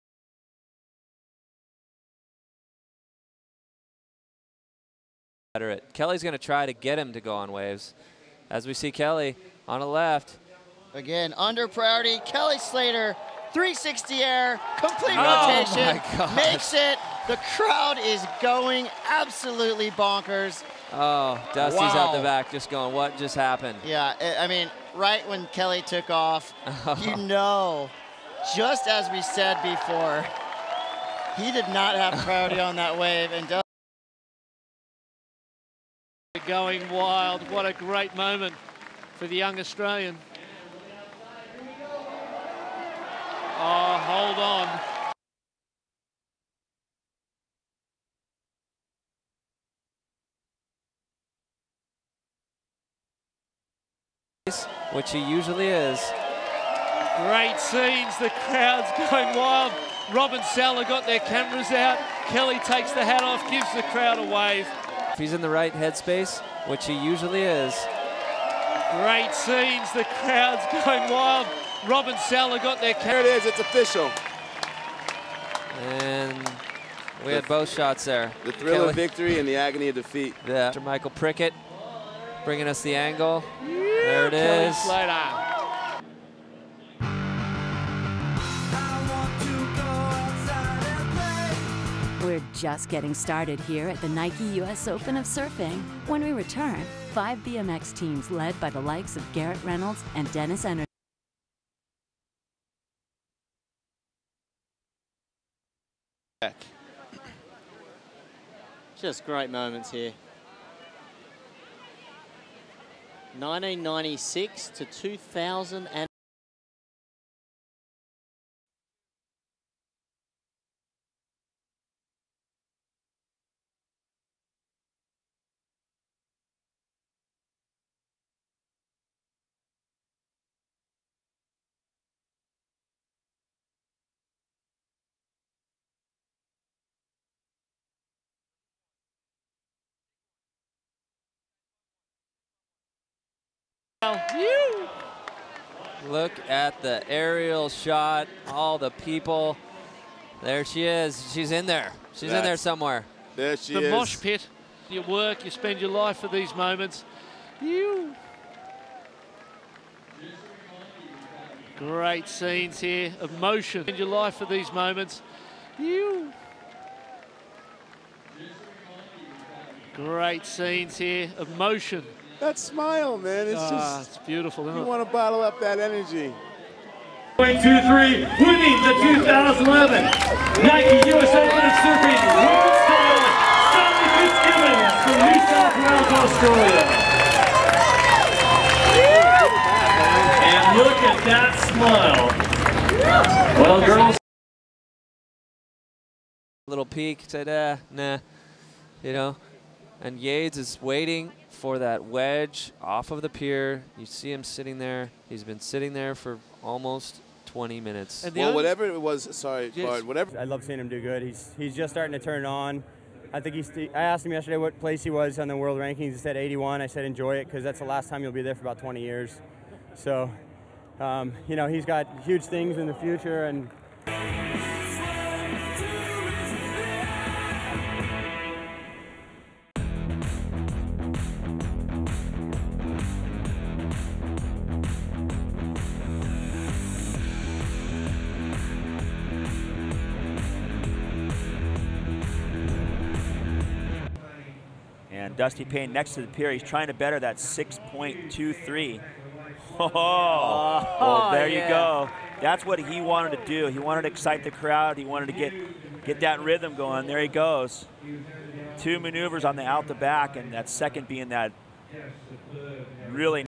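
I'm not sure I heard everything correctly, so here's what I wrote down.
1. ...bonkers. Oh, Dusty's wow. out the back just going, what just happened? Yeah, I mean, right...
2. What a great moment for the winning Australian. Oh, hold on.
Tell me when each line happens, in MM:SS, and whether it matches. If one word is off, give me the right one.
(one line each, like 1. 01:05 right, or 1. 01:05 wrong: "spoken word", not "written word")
1. 00:19 right
2. 00:37 wrong: "young", not "winning".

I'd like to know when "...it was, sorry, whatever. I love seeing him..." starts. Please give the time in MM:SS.
03:28.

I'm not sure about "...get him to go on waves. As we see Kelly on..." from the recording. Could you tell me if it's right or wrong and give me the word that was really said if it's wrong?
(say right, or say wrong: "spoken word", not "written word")
right.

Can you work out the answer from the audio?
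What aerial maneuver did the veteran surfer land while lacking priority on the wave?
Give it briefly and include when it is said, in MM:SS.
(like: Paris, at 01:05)
360 air, at 00:13.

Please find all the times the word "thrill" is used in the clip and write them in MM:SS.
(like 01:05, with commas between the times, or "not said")
01:18.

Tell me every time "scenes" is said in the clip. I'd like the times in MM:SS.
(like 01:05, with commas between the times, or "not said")
00:57, 01:09, 02:42, 02:50.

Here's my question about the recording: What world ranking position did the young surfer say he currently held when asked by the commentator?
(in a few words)
81.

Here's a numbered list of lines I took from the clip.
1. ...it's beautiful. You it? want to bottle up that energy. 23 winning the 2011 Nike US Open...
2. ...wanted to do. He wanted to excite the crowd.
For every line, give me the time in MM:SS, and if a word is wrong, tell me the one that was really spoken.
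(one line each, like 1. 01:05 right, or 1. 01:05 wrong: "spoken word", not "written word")
1. 02:54 right
2. 04:12 right.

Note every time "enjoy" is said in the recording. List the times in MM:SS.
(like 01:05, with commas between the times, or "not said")
03:37.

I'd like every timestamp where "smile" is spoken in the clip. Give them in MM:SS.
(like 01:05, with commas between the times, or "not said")
02:52, 03:11.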